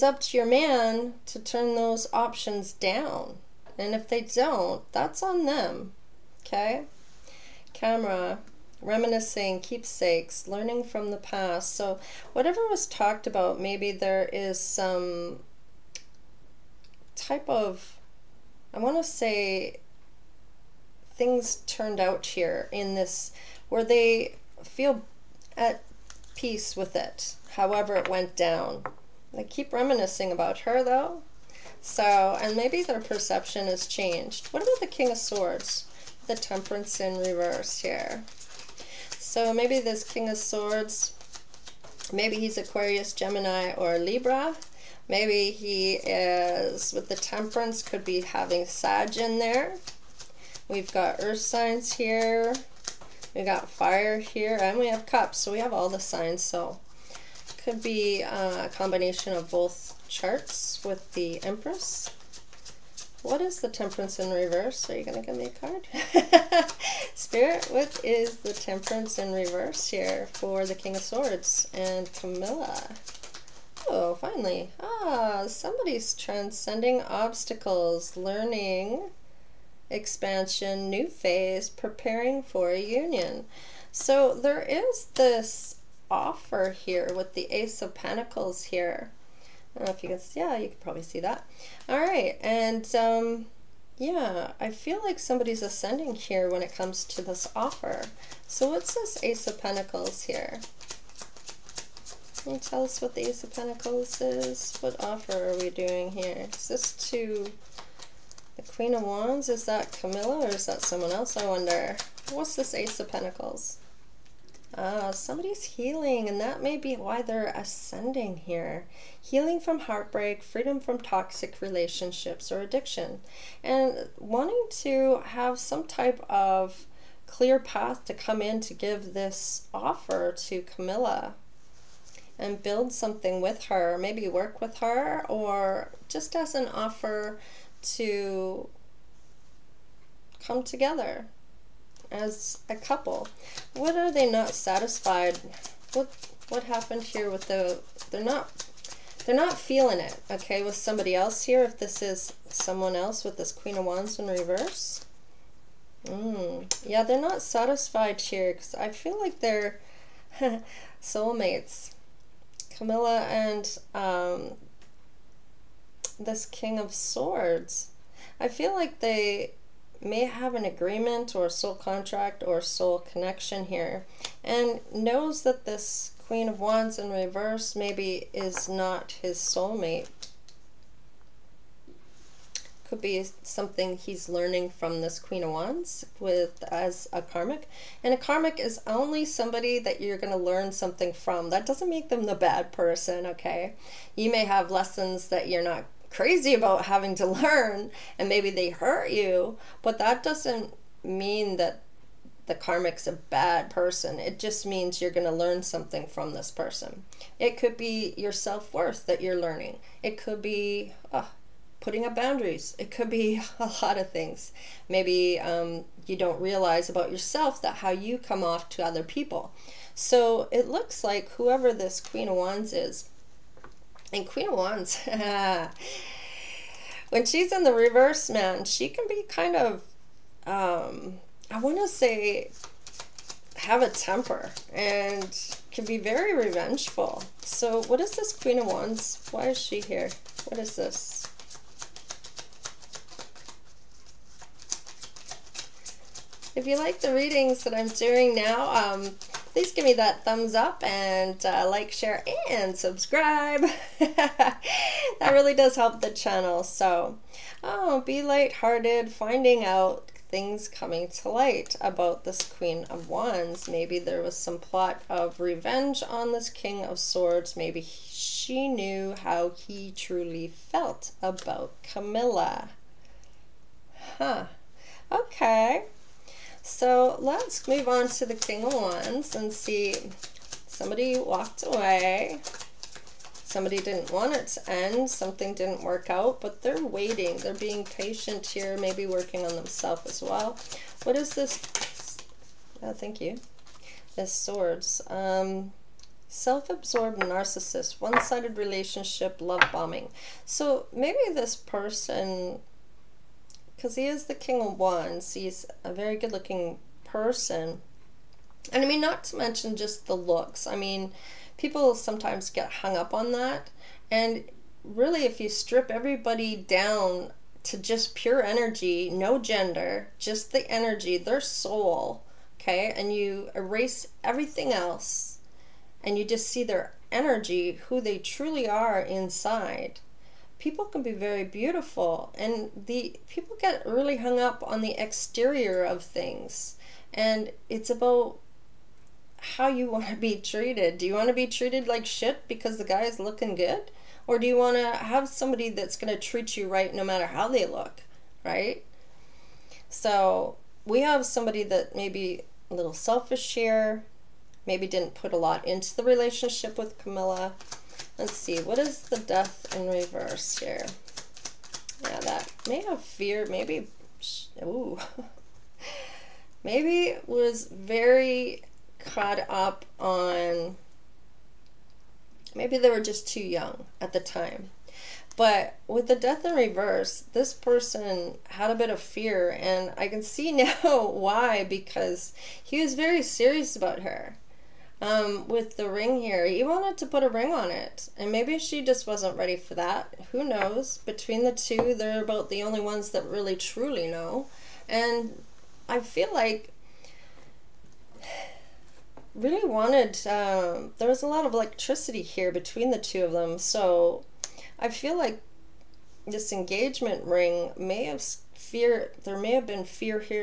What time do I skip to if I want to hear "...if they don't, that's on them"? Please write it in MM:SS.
00:03.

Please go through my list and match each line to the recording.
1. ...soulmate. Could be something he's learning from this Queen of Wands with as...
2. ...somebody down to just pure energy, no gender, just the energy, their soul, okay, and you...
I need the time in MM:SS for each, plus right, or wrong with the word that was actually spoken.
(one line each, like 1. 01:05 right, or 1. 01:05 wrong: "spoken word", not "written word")
1. 02:59 right
2. 05:15 wrong: "everybody", not "somebody".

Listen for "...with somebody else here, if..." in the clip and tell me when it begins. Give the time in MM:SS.
02:30.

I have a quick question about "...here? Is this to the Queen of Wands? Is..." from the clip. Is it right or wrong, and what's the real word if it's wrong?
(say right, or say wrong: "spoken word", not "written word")
right.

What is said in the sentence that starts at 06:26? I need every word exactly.
He wanted to put a ring on it, and maybe she just wasn't ready for that.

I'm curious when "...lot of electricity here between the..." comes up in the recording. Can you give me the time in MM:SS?
06:41.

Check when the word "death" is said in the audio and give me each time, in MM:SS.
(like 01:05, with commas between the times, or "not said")
05:59, 06:16.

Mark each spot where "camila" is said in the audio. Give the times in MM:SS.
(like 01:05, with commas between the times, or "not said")
01:12, 01:49, 02:10, 02:42, 04:31, 05:57.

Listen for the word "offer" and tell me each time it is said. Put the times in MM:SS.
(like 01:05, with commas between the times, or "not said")
01:26, 01:37, 01:45, 02:09, 02:16.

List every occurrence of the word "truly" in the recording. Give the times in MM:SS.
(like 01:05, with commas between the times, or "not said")
04:29, 05:28, 06:33.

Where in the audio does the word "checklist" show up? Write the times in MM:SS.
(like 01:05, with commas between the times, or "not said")
not said.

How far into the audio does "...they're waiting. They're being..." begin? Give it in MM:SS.
04:46.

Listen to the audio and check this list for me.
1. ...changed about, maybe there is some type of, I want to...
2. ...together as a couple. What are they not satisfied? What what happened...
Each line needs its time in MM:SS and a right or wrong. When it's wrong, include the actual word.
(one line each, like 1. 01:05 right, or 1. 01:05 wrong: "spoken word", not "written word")
1. 00:12 wrong: "talked", not "changed"
2. 02:20 right.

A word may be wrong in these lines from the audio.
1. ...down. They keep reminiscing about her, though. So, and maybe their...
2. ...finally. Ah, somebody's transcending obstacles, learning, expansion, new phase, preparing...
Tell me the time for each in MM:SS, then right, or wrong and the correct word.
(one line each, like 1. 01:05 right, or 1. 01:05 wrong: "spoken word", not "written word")
1. 00:28 right
2. 01:14 right.